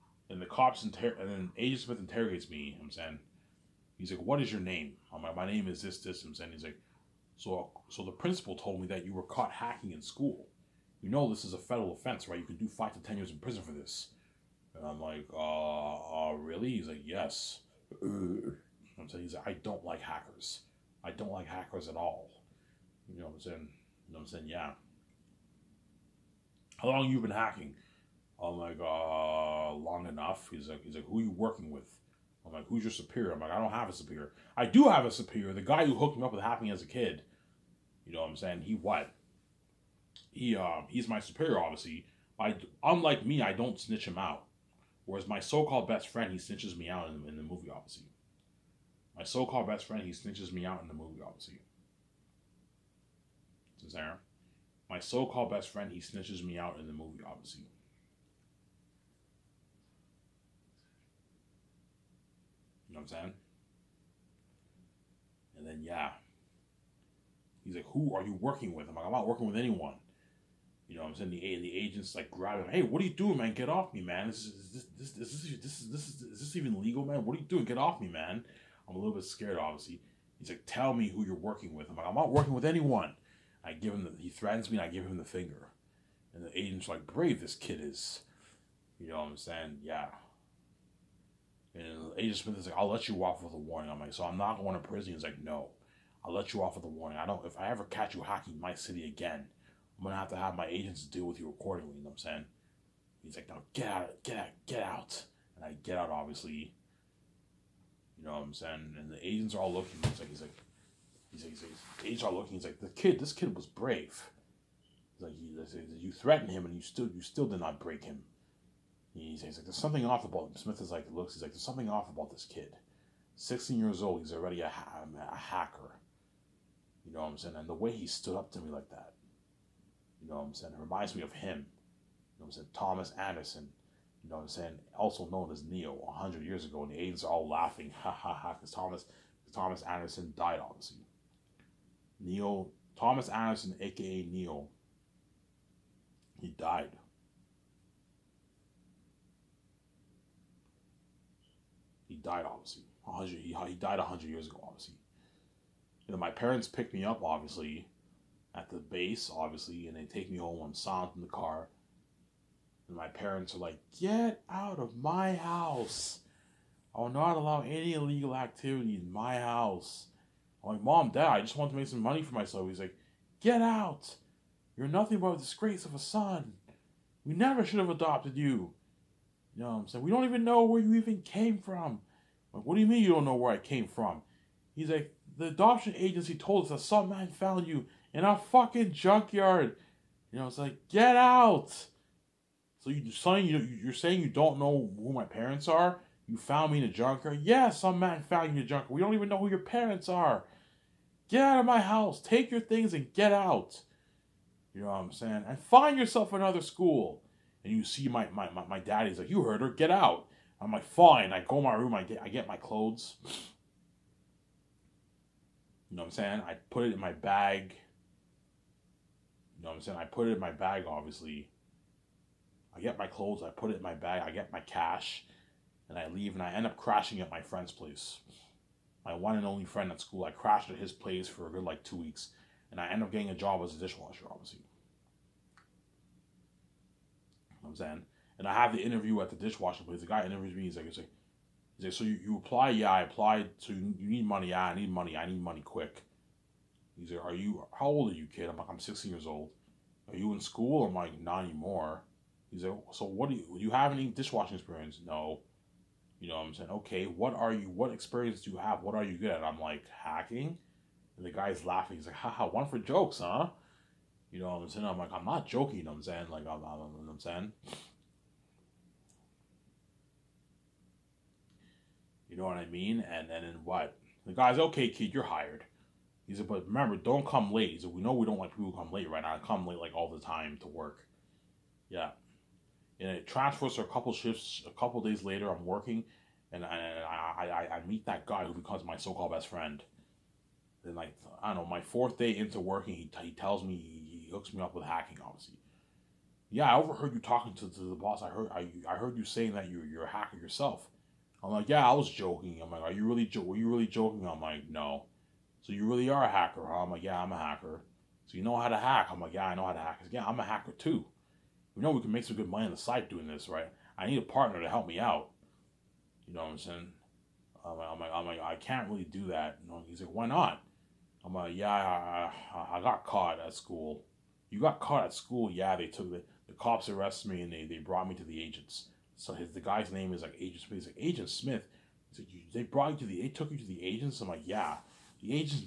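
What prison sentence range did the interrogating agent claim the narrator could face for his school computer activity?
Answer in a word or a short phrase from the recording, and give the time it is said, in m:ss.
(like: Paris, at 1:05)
5 to 10 years, at 0:12.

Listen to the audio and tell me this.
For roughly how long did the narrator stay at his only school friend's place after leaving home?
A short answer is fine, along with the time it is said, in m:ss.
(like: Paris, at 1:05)
2 weeks, at 3:51.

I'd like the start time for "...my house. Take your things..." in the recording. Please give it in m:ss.
3:21.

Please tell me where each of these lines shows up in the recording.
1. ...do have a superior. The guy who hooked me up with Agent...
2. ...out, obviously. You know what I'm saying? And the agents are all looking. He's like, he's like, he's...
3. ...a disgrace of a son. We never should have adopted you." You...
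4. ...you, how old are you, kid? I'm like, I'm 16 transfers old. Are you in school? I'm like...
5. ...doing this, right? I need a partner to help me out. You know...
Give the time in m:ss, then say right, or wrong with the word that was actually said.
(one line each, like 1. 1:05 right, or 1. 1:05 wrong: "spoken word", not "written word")
1. 0:34 wrong: "Happy", not "Agent"
2. 1:45 right
3. 2:55 right
4. 4:07 wrong: "years", not "transfers"
5. 5:13 right.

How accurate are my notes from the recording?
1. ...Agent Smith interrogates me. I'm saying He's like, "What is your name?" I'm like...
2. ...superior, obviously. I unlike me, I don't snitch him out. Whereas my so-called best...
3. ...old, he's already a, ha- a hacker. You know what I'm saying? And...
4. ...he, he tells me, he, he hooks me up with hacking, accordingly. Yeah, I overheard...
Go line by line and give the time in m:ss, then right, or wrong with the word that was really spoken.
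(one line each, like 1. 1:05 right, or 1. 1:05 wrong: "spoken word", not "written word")
1. 0:01 right
2. 0:41 right
3. 2:04 right
4. 4:52 wrong: "obviously", not "accordingly".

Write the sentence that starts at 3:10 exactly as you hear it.
You know, it's like, get out.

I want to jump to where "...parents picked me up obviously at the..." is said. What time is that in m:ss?
2:36.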